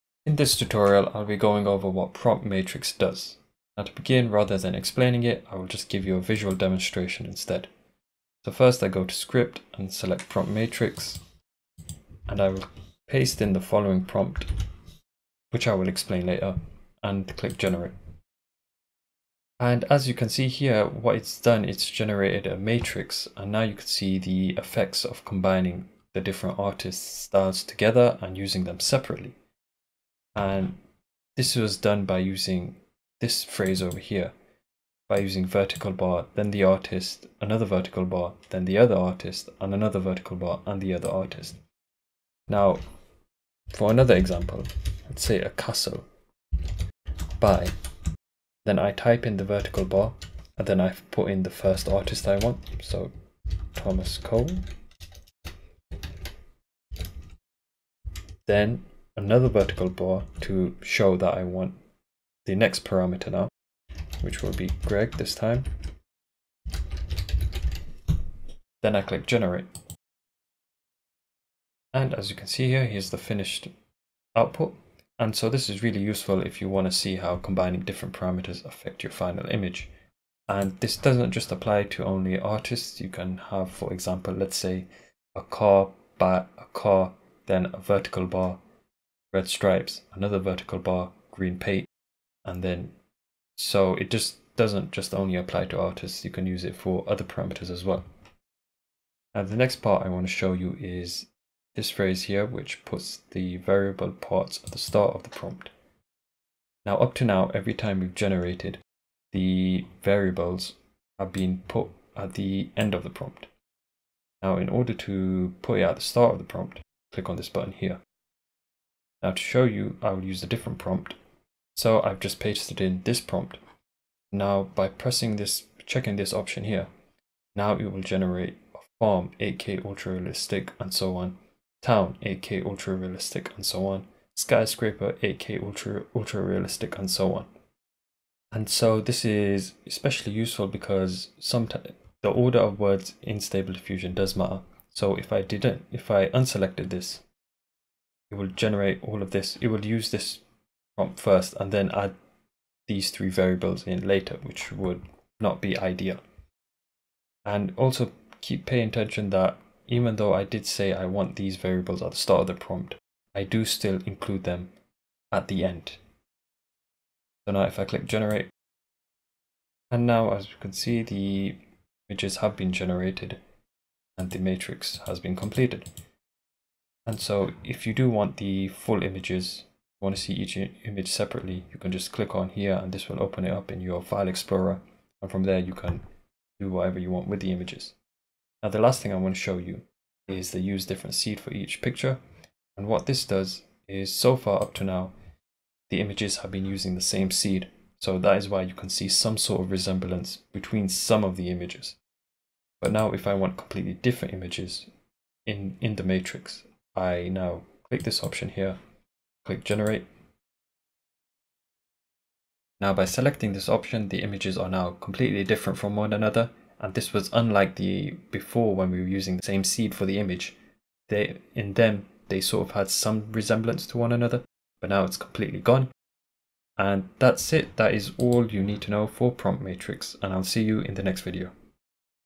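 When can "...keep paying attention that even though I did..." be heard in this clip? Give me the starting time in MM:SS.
02:38.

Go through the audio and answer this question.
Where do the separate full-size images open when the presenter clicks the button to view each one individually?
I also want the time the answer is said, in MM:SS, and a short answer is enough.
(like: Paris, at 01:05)
file explorer, at 03:04.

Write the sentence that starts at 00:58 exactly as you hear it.
Then another vertical bar to show that I want the next parameter now, which will be Greg this time.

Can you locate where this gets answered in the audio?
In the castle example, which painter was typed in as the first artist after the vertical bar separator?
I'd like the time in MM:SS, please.
00:53.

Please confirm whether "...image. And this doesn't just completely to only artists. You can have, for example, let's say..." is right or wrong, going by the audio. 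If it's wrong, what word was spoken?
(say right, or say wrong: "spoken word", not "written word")
wrong: "apply", not "completely".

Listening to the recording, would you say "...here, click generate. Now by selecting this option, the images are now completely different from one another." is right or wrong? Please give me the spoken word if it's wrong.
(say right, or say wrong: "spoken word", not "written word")
right.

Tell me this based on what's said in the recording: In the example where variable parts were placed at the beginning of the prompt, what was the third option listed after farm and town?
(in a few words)
skyscraper.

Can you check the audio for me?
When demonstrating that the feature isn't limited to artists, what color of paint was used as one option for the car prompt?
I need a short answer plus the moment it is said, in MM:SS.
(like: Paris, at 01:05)
green, at 01:31.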